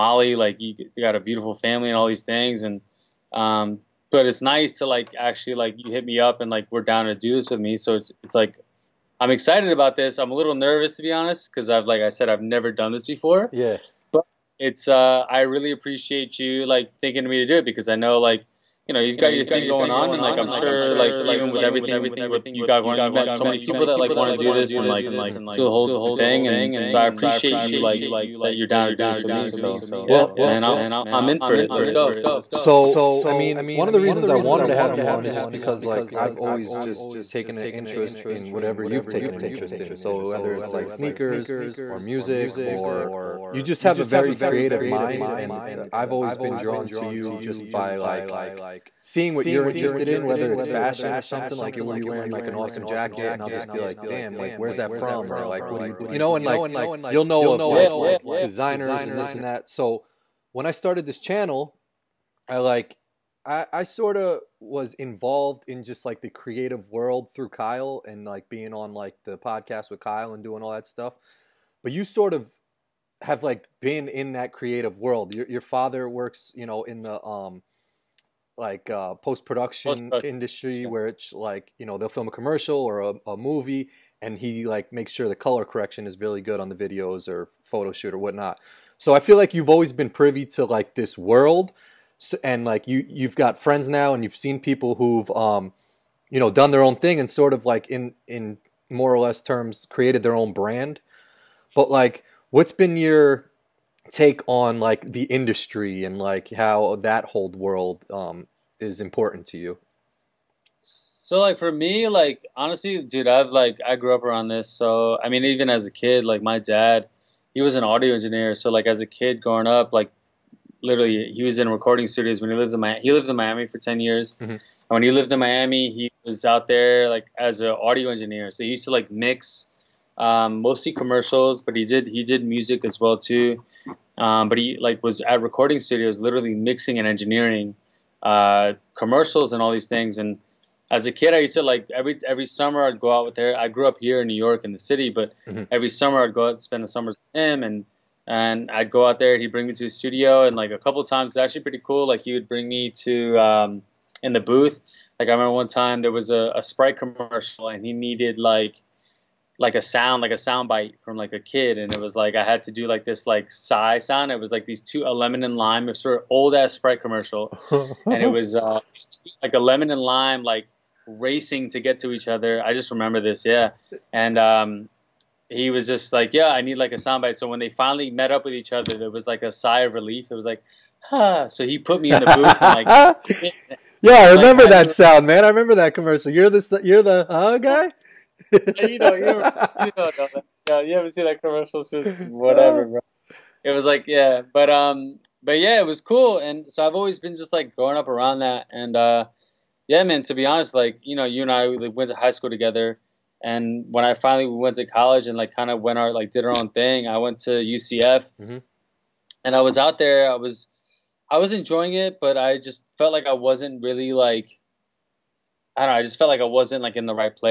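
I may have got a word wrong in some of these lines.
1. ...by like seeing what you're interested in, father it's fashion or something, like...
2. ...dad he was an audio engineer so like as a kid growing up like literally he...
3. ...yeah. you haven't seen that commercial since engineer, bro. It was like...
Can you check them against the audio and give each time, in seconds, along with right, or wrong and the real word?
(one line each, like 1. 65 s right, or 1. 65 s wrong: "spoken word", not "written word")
1. 47 s wrong: "whether", not "father"
2. 116 s right
3. 190 s wrong: "whatever", not "engineer".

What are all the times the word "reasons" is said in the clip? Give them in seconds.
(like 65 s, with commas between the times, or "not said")
33 s.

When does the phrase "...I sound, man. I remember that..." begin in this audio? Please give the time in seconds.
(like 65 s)
184 s.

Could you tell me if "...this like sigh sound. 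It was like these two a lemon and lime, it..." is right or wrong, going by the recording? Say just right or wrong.
right.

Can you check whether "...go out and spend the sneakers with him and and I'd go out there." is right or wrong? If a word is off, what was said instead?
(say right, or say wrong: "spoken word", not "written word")
wrong: "summers", not "sneakers".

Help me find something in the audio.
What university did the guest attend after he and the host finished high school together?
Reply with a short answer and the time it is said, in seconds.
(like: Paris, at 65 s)
UCF, at 207 s.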